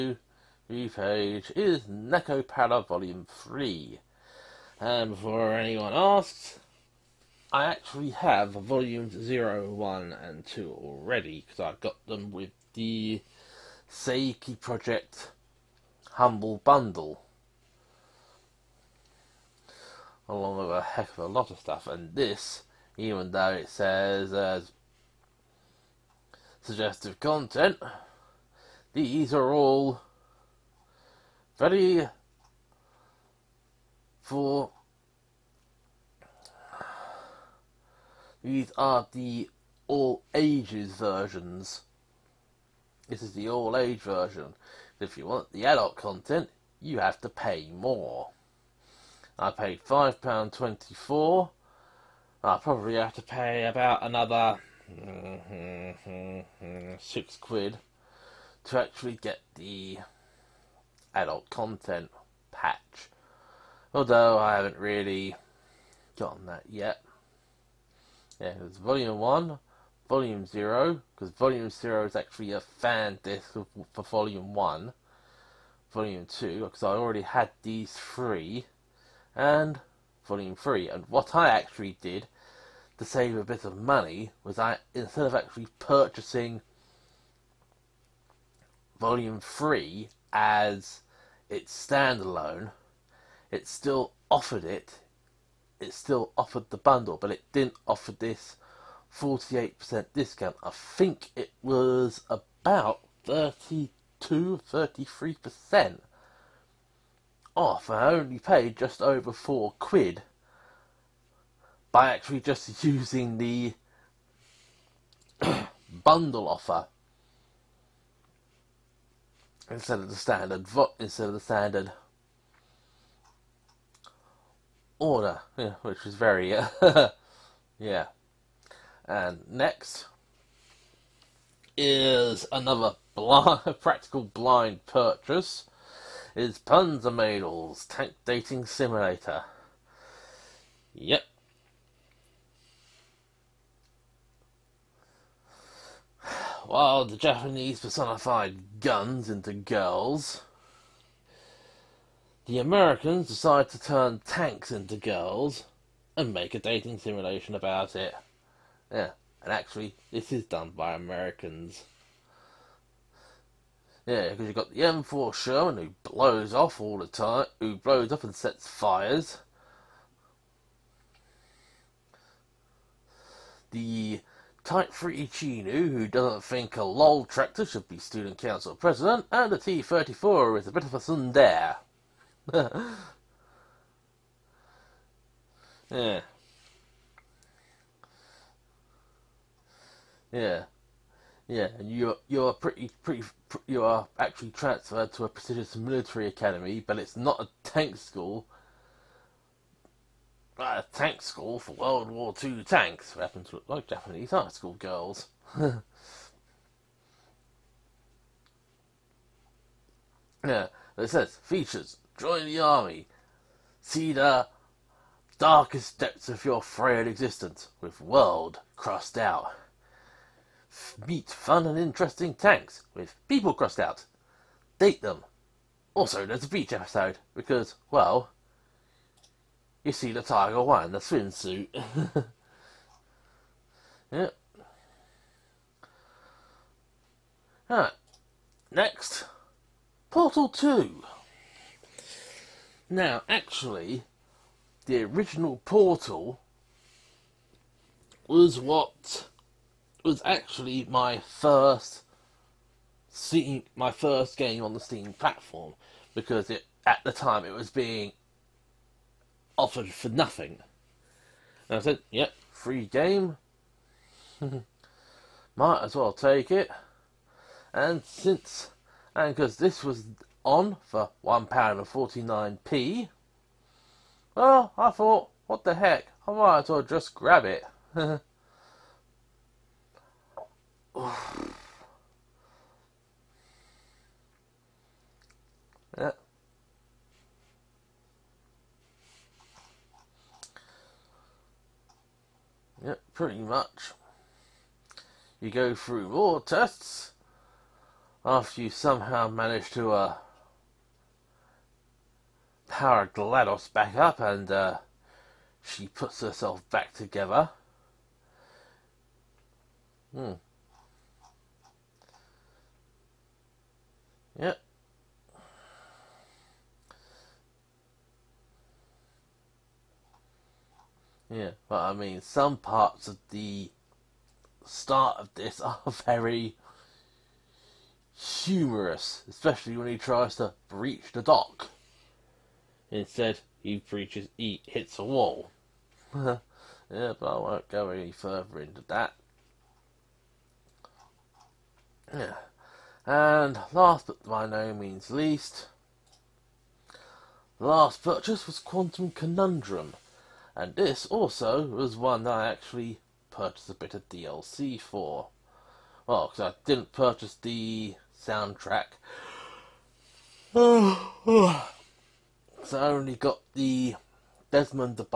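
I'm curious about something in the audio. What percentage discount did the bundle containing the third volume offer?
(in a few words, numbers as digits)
48%.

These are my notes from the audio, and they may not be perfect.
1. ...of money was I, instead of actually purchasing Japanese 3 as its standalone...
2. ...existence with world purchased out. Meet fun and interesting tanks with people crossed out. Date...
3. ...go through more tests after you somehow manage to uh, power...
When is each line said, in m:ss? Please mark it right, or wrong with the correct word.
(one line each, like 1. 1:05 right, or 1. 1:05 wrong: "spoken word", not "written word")
1. 1:23 wrong: "Volume", not "Japanese"
2. 3:37 wrong: "crossed", not "purchased"
3. 4:55 right.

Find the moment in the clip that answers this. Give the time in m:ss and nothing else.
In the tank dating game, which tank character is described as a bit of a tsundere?
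2:59.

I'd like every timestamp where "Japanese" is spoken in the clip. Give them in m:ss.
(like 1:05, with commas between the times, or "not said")
2:27, 3:23.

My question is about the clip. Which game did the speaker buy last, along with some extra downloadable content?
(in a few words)
Quantum Conundrum.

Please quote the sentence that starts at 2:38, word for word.
Yeah, and actually, this is done by Americans.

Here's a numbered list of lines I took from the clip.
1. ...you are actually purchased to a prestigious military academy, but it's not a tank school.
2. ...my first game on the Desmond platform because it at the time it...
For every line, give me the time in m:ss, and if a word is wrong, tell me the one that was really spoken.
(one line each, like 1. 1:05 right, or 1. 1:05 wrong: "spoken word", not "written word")
1. 3:13 wrong: "transferred", not "purchased"
2. 4:13 wrong: "Steam", not "Desmond".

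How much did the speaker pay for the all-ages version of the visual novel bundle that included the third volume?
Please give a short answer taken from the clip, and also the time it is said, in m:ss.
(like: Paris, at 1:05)
£5.24, at 0:49.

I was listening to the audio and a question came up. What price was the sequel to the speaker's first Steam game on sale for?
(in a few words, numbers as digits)
£1.49.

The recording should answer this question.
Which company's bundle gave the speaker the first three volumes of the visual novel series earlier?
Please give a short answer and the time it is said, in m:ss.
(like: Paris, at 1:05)
Sekai Project, at 0:13.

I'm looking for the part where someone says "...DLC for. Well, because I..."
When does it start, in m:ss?
5:54.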